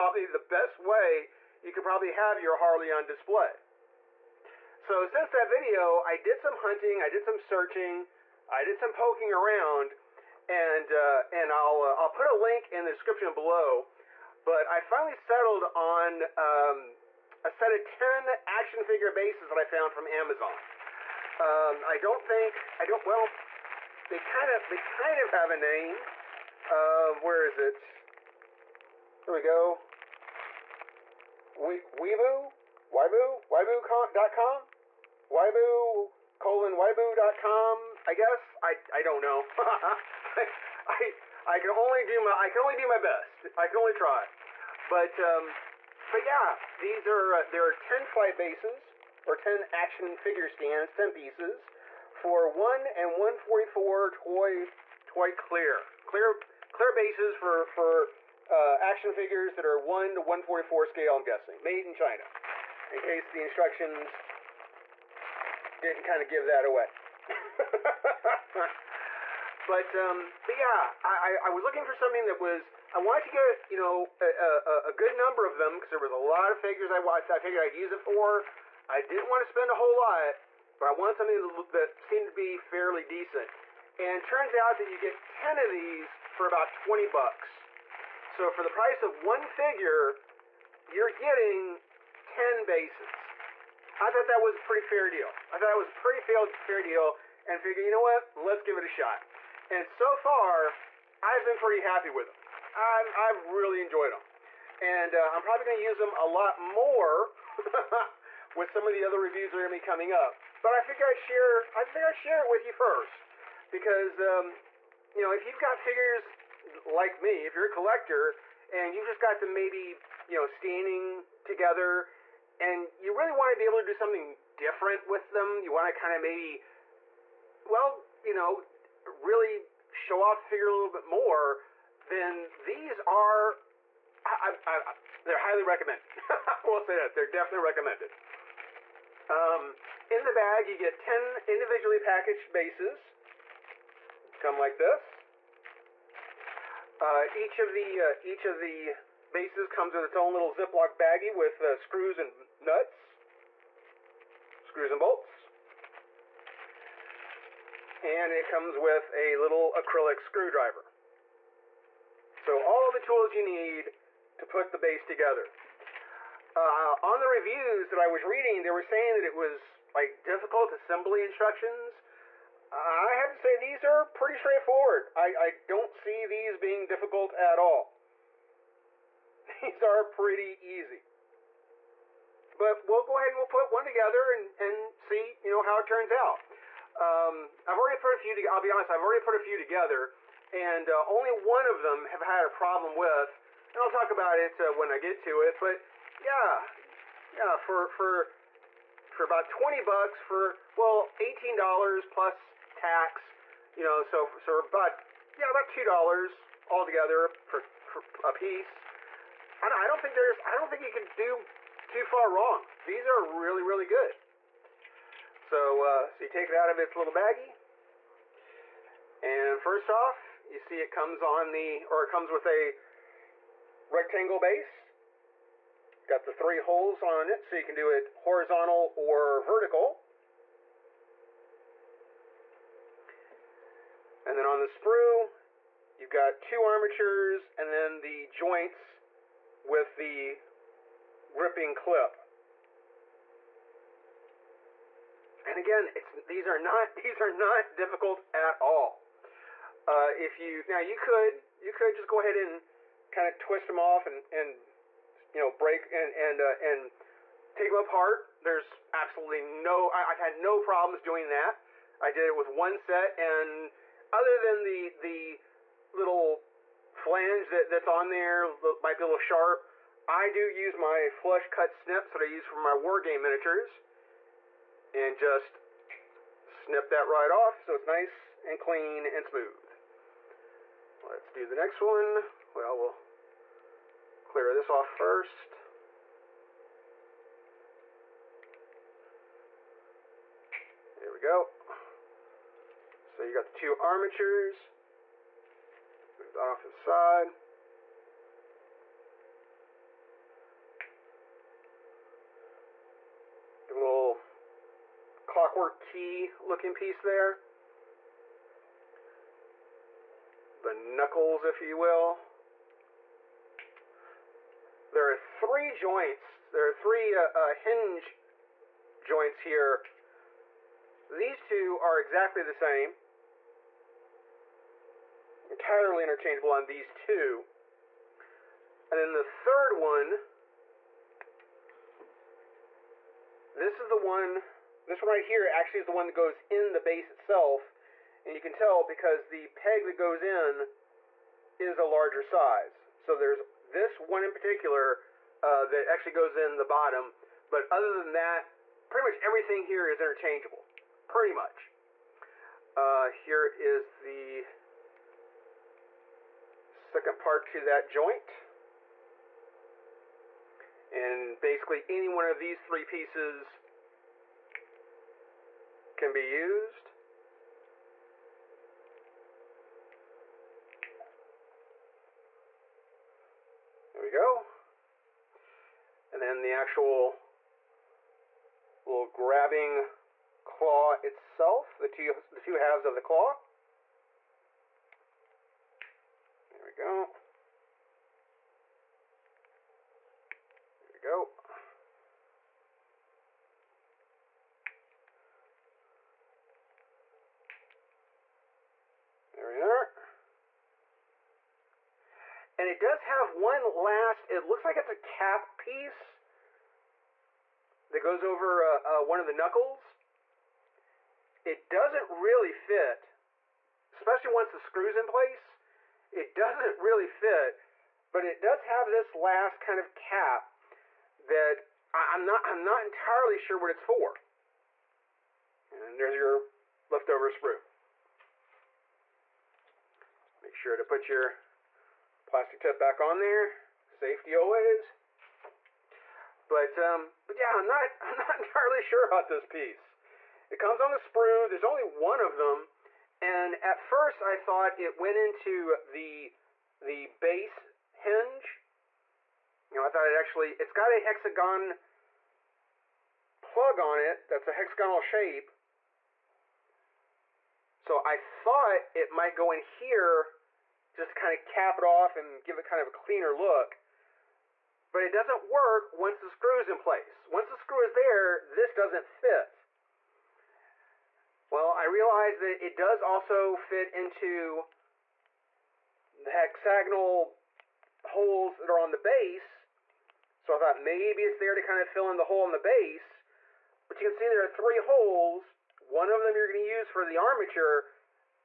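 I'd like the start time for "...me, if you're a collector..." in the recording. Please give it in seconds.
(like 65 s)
117 s.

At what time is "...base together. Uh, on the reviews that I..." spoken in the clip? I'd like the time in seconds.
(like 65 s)
164 s.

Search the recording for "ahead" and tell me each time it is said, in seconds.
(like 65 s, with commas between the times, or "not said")
183 s, 252 s.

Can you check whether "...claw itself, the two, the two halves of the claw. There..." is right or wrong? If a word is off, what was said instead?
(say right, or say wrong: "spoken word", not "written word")
right.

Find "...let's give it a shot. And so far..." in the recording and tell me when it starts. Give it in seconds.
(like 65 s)
98 s.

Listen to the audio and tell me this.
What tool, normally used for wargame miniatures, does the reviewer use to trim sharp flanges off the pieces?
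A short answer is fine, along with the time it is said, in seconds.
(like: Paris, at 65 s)
flush cut snips, at 271 s.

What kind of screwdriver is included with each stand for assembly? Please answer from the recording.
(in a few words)
acrylic screwdriver.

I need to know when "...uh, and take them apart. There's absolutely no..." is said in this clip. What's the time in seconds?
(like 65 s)
256 s.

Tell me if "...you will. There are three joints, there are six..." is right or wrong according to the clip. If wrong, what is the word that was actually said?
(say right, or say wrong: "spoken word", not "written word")
wrong: "three", not "six".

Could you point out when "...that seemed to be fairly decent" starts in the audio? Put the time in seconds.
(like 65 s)
81 s.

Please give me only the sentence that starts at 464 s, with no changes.
But it doesn't work once the screw's in place.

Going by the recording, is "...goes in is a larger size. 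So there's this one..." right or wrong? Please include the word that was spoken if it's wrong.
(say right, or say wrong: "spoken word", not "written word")
right.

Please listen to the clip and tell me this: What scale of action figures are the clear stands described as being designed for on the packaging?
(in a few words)
1 to 144.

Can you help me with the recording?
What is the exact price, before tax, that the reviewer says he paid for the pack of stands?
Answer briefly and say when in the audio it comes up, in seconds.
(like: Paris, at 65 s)
$18, at 201 s.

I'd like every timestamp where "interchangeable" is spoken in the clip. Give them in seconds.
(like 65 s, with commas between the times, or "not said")
326 s, 350 s.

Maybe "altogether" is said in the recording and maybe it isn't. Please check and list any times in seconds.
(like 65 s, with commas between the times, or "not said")
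206 s.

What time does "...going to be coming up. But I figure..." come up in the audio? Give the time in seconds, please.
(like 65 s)
109 s.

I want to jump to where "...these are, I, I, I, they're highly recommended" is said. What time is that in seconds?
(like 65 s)
132 s.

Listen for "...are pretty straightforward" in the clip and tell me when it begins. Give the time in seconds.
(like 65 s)
173 s.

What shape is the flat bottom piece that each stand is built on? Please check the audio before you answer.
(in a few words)
rectangle.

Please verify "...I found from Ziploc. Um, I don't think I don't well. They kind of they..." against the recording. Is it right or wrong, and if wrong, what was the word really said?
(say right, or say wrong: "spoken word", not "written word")
wrong: "Amazon", not "Ziploc".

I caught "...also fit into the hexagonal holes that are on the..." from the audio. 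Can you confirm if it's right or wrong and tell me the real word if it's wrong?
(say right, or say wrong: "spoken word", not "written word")
right.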